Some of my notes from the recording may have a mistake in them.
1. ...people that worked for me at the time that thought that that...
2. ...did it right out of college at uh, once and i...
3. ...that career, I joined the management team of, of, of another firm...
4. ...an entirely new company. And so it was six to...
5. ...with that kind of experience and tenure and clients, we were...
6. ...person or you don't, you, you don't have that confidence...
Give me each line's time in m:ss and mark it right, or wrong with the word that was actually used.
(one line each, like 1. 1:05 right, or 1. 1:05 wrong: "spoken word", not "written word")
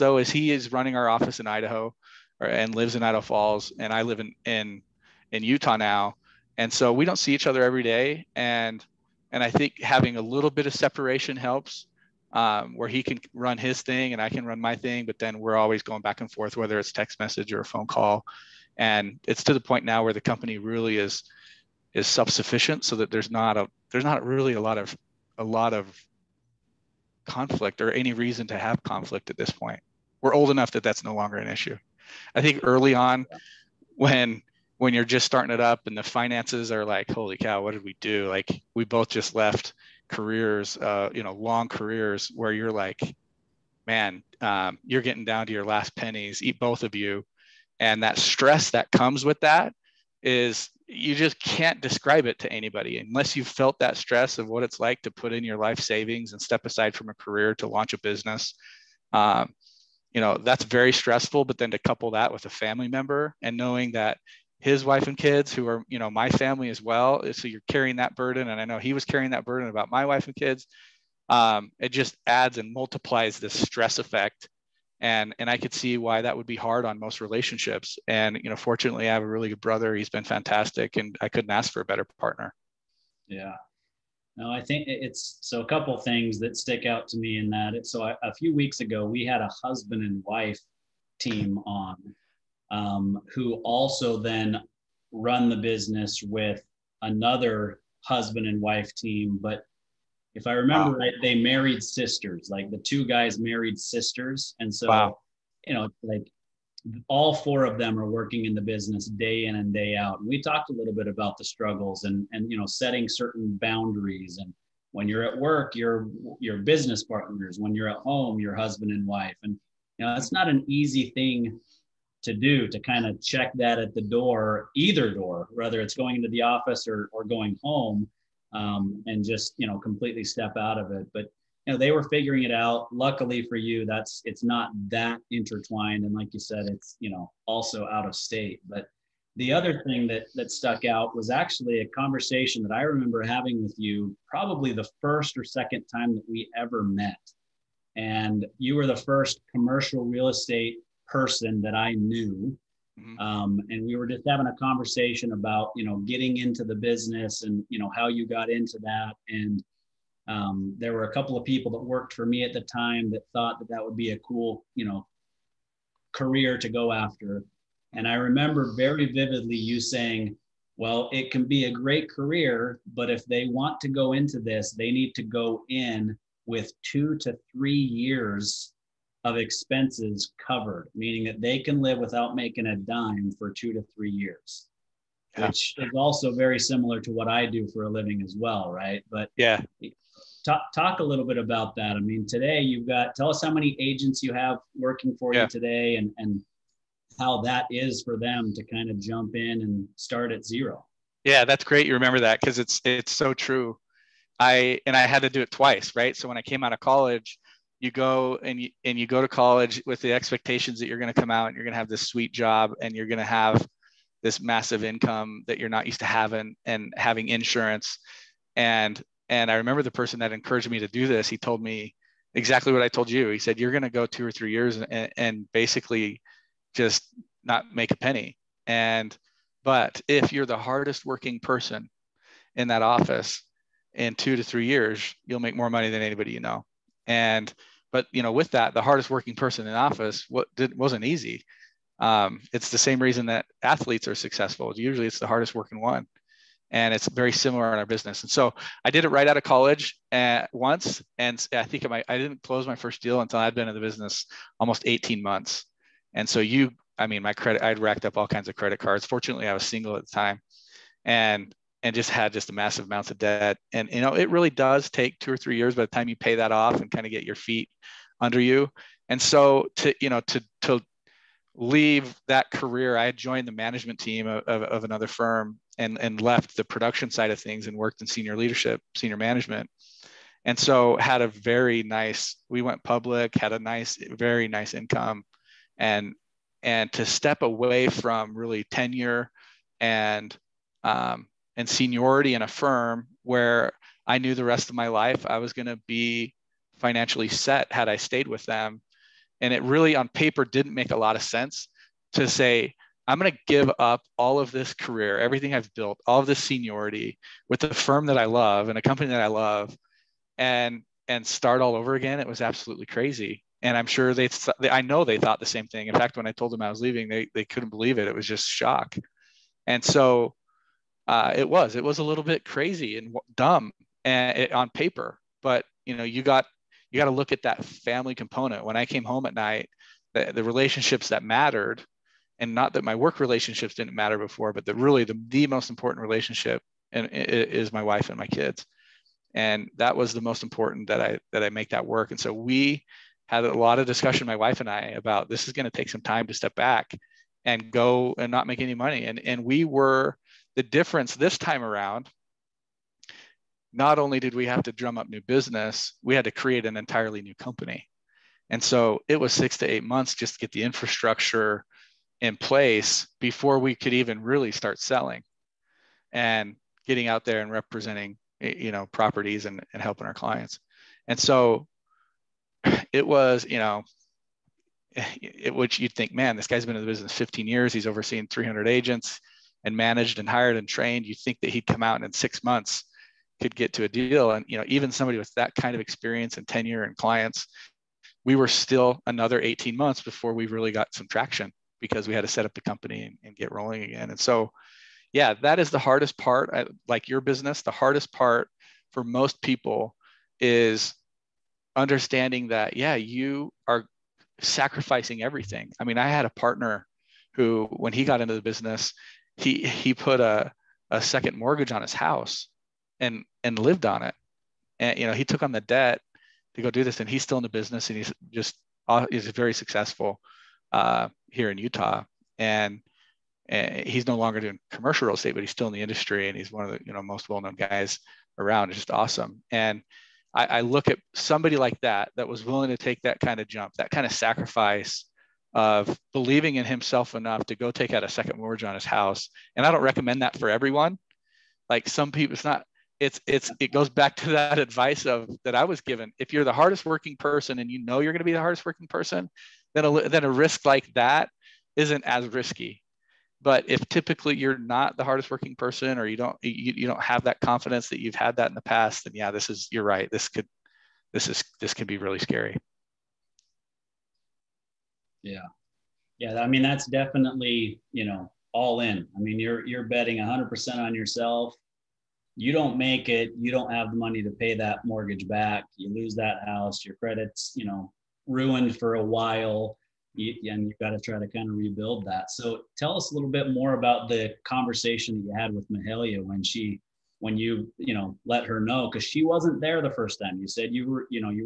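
1. 2:41 right
2. 4:08 right
3. 4:32 right
4. 5:56 right
5. 6:25 right
6. 7:35 right.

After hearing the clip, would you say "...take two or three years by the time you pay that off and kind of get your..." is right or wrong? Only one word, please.
right.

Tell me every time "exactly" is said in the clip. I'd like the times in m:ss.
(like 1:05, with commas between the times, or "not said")
3:42.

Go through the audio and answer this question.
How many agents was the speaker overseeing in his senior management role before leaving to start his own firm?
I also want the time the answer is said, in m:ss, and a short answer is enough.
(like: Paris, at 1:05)
300, at 6:18.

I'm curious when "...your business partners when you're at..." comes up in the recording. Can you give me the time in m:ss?
1:56.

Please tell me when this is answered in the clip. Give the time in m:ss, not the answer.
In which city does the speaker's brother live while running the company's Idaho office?
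0:03.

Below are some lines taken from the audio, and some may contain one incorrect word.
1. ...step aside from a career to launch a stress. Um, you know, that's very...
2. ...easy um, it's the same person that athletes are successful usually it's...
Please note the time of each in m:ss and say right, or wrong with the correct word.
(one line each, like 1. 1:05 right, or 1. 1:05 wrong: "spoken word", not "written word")
1. 0:56 wrong: "business", not "stress"
2. 4:01 wrong: "reason", not "person".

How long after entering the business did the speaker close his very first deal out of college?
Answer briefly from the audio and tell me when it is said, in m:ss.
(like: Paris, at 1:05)
almost 18 months, at 4:14.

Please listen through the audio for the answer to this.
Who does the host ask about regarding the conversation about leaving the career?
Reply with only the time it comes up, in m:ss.
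8:05.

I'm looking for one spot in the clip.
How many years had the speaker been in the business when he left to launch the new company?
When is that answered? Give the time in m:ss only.
6:17.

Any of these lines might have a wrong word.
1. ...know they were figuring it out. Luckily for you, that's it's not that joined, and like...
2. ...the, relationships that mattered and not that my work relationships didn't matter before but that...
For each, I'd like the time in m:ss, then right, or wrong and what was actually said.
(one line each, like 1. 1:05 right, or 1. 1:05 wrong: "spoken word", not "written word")
1. 2:11 wrong: "intertwined", not "joined"
2. 5:30 right.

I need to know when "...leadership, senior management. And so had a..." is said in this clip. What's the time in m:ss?
4:38.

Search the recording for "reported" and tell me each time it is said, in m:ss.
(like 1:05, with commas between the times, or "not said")
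not said.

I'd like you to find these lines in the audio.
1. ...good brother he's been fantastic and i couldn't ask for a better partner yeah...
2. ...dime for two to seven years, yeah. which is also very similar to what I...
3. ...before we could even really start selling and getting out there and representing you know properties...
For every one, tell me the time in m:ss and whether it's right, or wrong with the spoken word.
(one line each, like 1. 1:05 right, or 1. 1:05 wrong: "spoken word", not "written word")
1. 1:19 right
2. 3:02 wrong: "three", not "seven"
3. 6:03 right.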